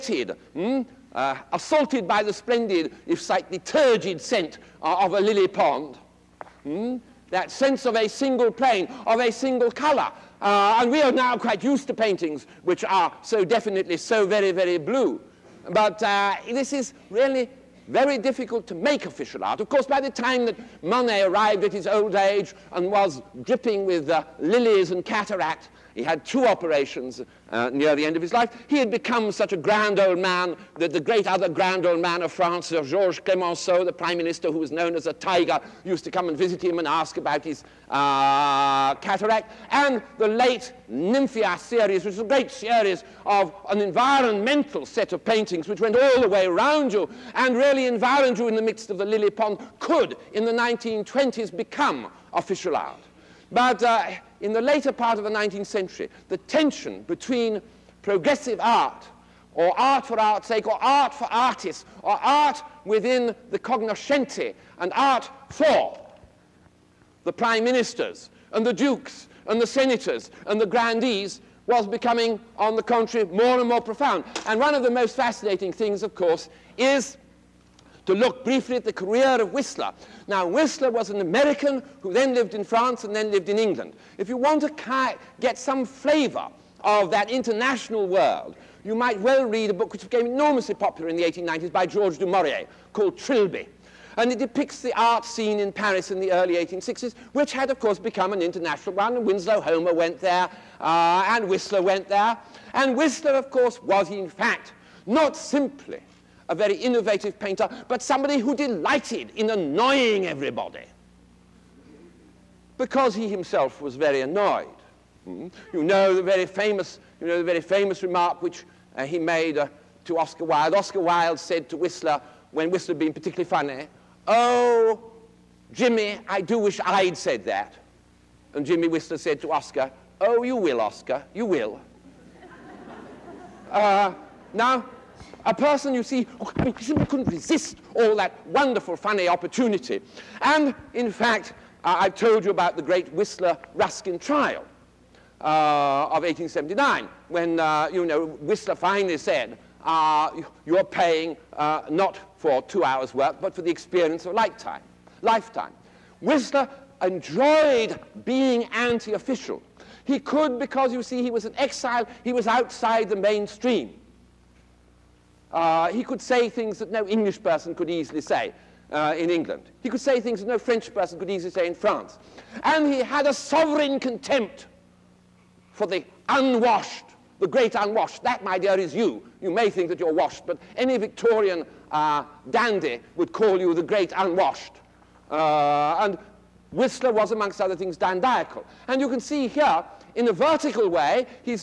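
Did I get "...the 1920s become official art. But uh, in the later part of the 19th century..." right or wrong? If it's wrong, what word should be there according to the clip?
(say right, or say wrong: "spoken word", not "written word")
right.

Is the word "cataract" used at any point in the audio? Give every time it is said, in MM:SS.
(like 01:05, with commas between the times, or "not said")
00:25, 00:38.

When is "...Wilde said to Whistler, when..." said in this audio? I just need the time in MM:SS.
02:00.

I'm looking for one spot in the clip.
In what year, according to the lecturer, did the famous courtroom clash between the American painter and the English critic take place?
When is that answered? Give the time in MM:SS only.
02:26.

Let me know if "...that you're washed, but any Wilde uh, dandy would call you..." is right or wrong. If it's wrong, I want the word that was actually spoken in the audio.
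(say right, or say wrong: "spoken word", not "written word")
wrong: "Victorian", not "Wilde".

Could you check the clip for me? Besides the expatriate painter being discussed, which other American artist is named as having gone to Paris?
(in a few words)
Winslow Homer.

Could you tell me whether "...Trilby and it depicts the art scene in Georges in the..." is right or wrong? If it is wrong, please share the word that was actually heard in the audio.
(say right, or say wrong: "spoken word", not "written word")
wrong: "Paris", not "Georges".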